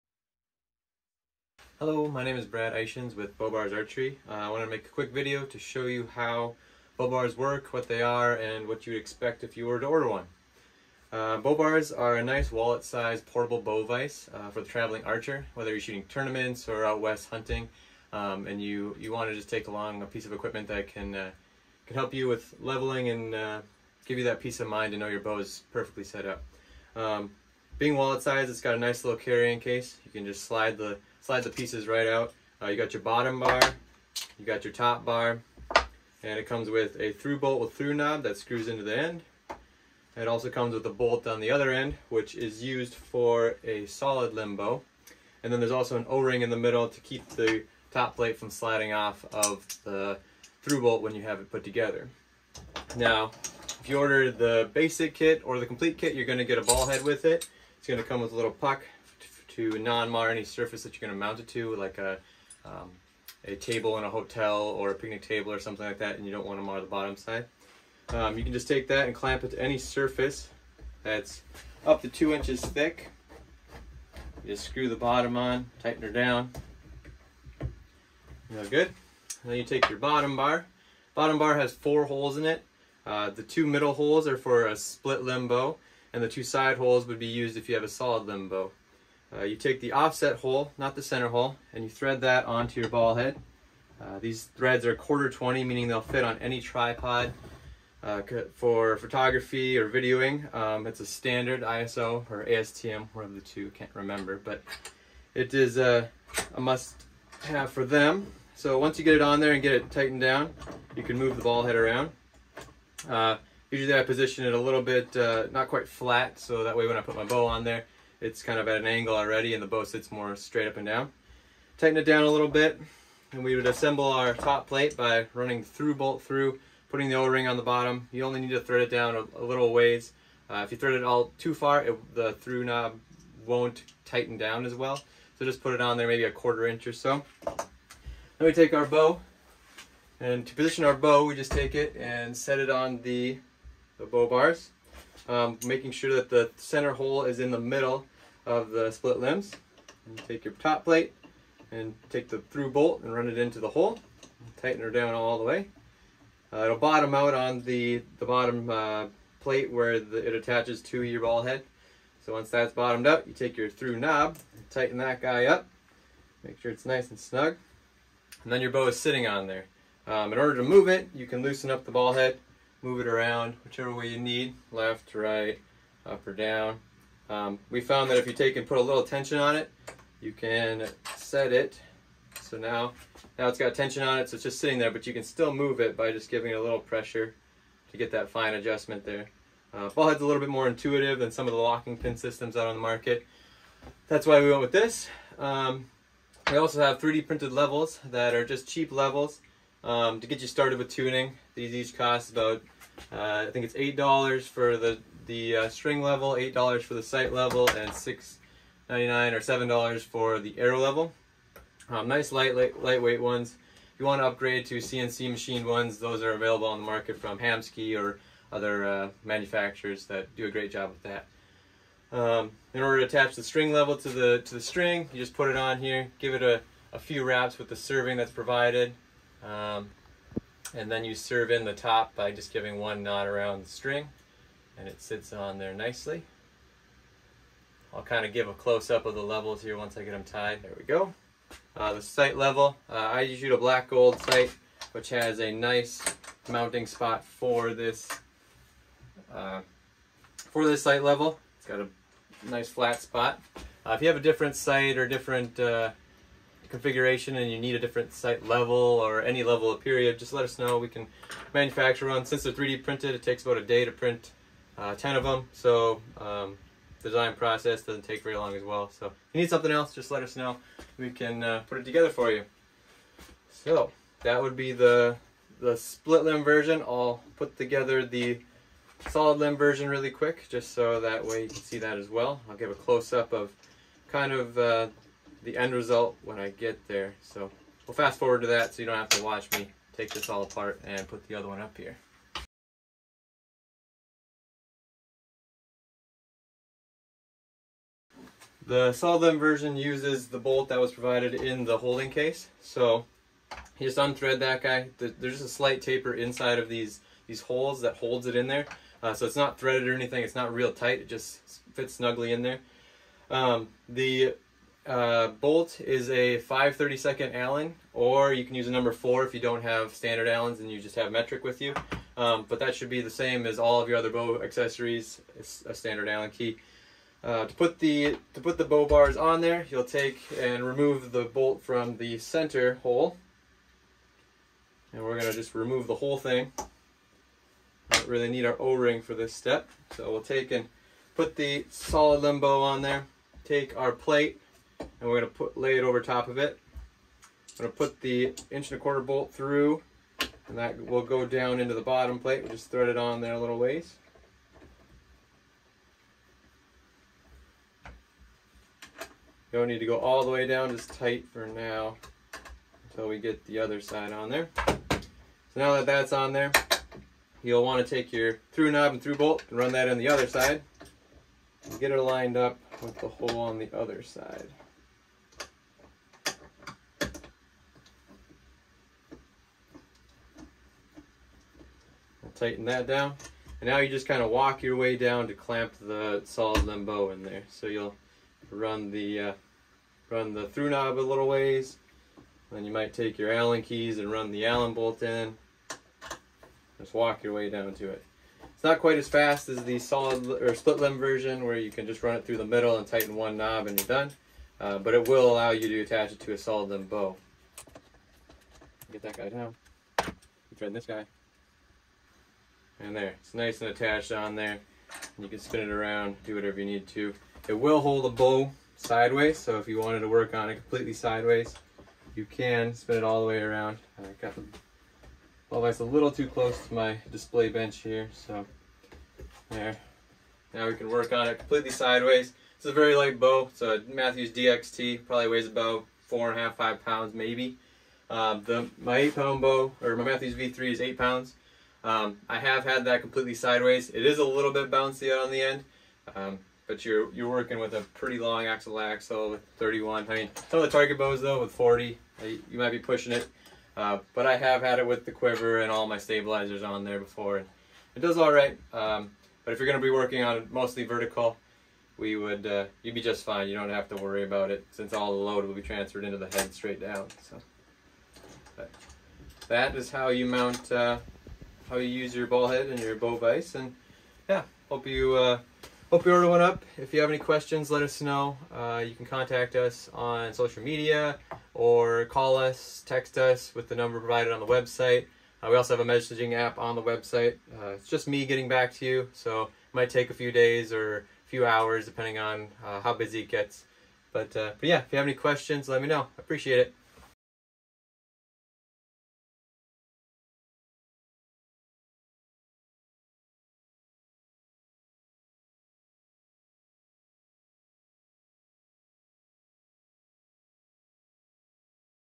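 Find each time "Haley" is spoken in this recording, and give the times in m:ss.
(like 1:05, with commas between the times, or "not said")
not said.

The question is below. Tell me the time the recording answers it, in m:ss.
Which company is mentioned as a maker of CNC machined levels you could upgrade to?
3:37.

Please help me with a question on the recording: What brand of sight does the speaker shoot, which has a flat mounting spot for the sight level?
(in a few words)
Black Gold.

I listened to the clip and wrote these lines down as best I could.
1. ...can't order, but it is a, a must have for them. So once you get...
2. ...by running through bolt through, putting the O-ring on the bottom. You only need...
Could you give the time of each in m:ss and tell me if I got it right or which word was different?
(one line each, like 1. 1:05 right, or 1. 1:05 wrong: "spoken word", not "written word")
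1. 1:43 wrong: "remember", not "order"
2. 2:04 right.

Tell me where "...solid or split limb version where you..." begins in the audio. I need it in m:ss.
6:39.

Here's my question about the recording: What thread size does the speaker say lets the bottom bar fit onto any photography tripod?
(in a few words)
quarter 20.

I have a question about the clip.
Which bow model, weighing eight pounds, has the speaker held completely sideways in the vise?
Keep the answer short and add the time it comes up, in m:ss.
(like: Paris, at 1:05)
Mathews V3, at 7:20.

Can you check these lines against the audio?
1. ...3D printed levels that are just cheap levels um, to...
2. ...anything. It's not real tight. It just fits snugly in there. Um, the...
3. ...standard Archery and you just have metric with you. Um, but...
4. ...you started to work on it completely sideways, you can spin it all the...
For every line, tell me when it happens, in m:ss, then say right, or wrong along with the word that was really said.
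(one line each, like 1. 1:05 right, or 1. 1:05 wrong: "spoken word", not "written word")
1. 3:16 right
2. 5:09 right
3. 5:19 wrong: "Allens", not "Archery"
4. 6:59 wrong: "wanted", not "started".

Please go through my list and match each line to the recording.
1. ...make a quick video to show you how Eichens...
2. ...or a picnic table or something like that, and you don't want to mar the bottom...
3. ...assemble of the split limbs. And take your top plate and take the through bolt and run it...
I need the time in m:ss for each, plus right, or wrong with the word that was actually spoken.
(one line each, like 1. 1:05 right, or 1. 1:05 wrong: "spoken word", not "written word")
1. 0:04 wrong: "BowBars", not "Eichens"
2. 1:04 right
3. 2:27 wrong: "middle", not "assemble".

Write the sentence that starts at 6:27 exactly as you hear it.
So you'll run the uh, run the through knob a little ways.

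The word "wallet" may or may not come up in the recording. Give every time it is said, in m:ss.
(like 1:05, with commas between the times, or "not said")
0:12, 0:27.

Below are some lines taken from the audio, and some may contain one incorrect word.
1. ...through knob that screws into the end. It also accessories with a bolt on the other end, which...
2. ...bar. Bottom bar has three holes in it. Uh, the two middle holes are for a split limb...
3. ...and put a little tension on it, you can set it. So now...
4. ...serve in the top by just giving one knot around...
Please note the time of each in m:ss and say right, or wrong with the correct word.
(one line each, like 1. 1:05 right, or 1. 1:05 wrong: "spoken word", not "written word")
1. 0:37 wrong: "comes", not "accessories"
2. 1:20 wrong: "four", not "three"
3. 2:58 right
4. 3:51 right.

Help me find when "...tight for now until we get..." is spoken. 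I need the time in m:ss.
6:00.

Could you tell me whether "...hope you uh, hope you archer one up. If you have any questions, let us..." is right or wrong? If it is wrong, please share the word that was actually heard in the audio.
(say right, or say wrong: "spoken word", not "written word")
wrong: "order", not "archer".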